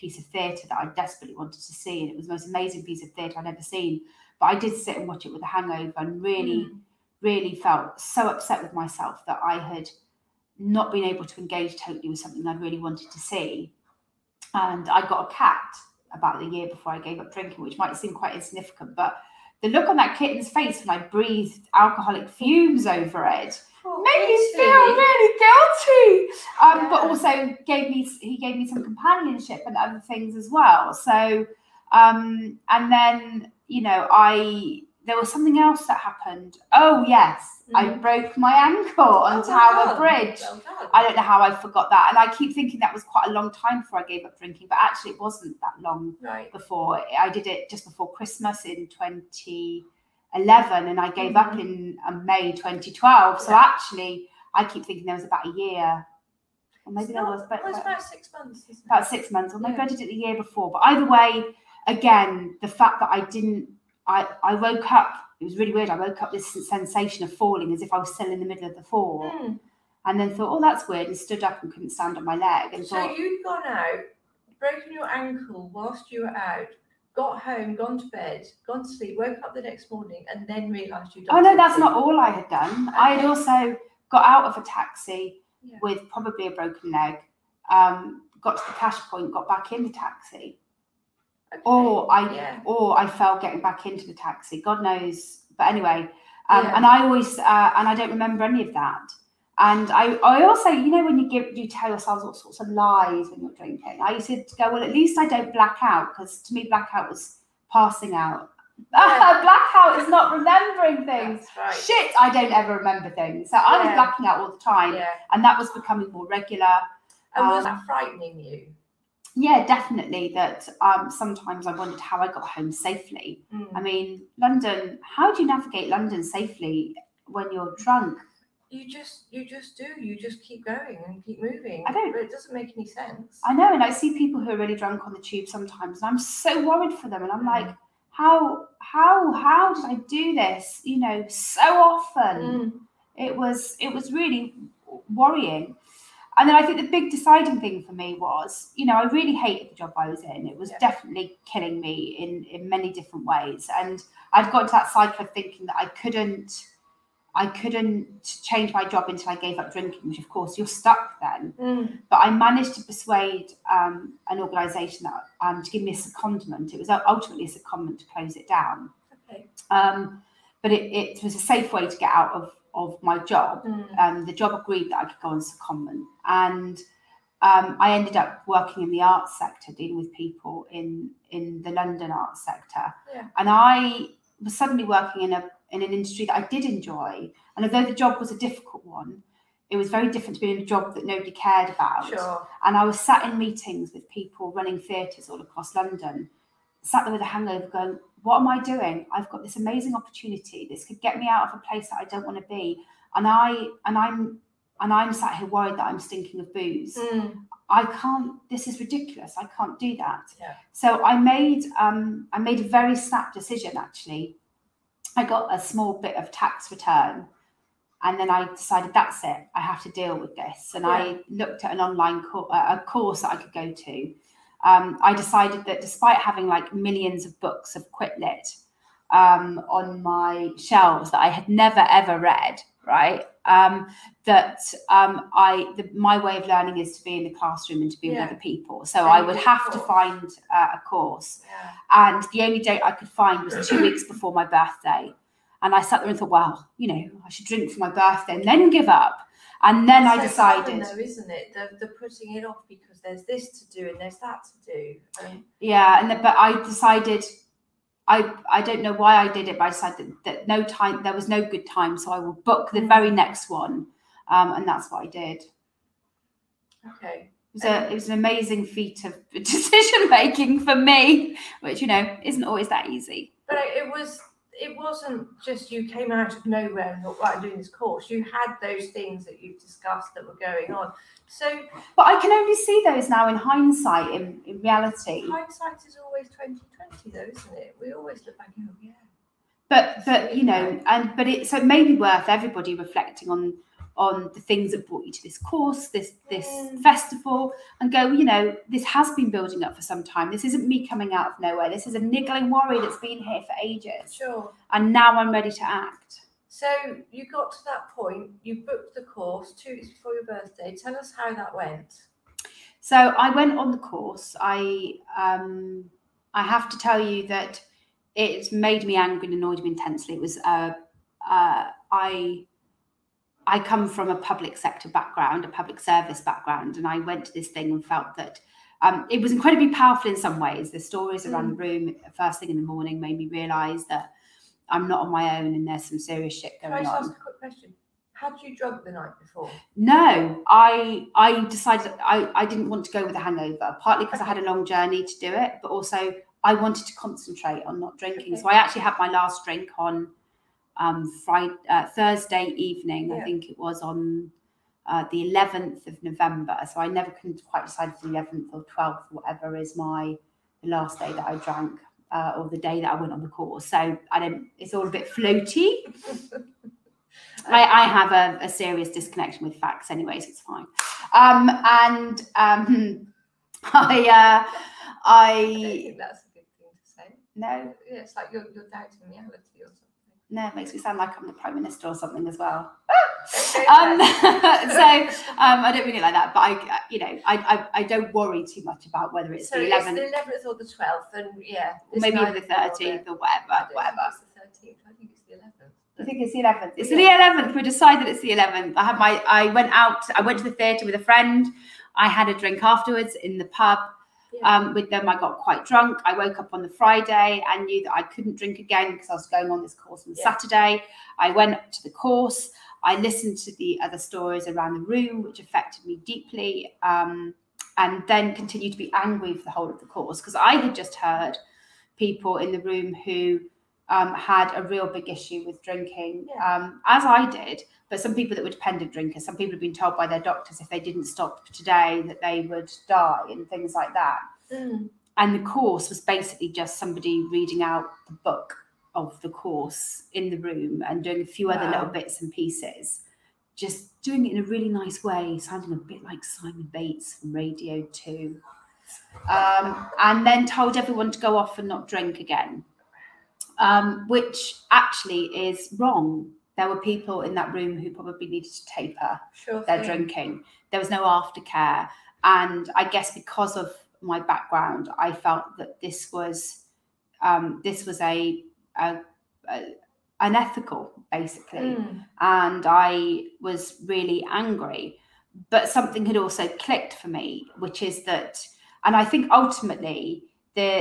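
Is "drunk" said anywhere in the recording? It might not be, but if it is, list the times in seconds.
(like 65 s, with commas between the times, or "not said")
127 s, 134 s, 338 s, 405 s.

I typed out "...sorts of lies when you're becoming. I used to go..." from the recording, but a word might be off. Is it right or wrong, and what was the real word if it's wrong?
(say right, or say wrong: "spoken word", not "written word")
wrong: "drinking", not "becoming".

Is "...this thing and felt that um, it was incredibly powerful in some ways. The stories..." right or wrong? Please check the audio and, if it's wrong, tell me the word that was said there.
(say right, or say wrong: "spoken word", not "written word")
right.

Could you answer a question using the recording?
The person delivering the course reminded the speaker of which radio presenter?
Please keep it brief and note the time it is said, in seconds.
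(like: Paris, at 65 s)
Simon Bates, at 446 s.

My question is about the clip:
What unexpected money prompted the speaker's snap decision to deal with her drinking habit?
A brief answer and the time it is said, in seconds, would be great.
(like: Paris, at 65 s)
Tax return, at 216 s.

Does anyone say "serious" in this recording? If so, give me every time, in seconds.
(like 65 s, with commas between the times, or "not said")
335 s, 368 s.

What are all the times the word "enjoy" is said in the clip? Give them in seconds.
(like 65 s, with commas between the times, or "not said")
186 s.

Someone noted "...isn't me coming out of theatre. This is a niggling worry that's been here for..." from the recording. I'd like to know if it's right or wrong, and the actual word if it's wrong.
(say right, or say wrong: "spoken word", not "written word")
wrong: "nowhere", not "theatre".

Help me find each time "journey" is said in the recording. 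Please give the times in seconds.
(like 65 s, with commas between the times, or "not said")
344 s.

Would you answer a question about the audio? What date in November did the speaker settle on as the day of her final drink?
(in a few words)
11th of November.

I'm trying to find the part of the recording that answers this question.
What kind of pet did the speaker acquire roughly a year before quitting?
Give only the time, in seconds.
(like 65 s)
15 s.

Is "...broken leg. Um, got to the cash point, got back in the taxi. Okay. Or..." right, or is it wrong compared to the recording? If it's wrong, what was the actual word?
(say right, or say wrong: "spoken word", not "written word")
right.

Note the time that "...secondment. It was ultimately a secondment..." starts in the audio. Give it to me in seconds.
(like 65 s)
165 s.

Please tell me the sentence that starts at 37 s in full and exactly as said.
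I broke my ankle on oh, Tower well Bridge.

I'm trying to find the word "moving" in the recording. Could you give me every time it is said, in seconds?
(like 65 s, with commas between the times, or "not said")
131 s.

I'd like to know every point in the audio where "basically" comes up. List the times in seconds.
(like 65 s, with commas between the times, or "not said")
435 s, 471 s.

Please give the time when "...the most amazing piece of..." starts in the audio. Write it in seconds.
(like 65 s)
2 s.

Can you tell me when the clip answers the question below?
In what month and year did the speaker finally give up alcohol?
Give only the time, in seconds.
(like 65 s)
52 s.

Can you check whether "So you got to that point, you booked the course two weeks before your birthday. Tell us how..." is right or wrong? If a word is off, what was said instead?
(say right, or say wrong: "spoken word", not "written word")
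right.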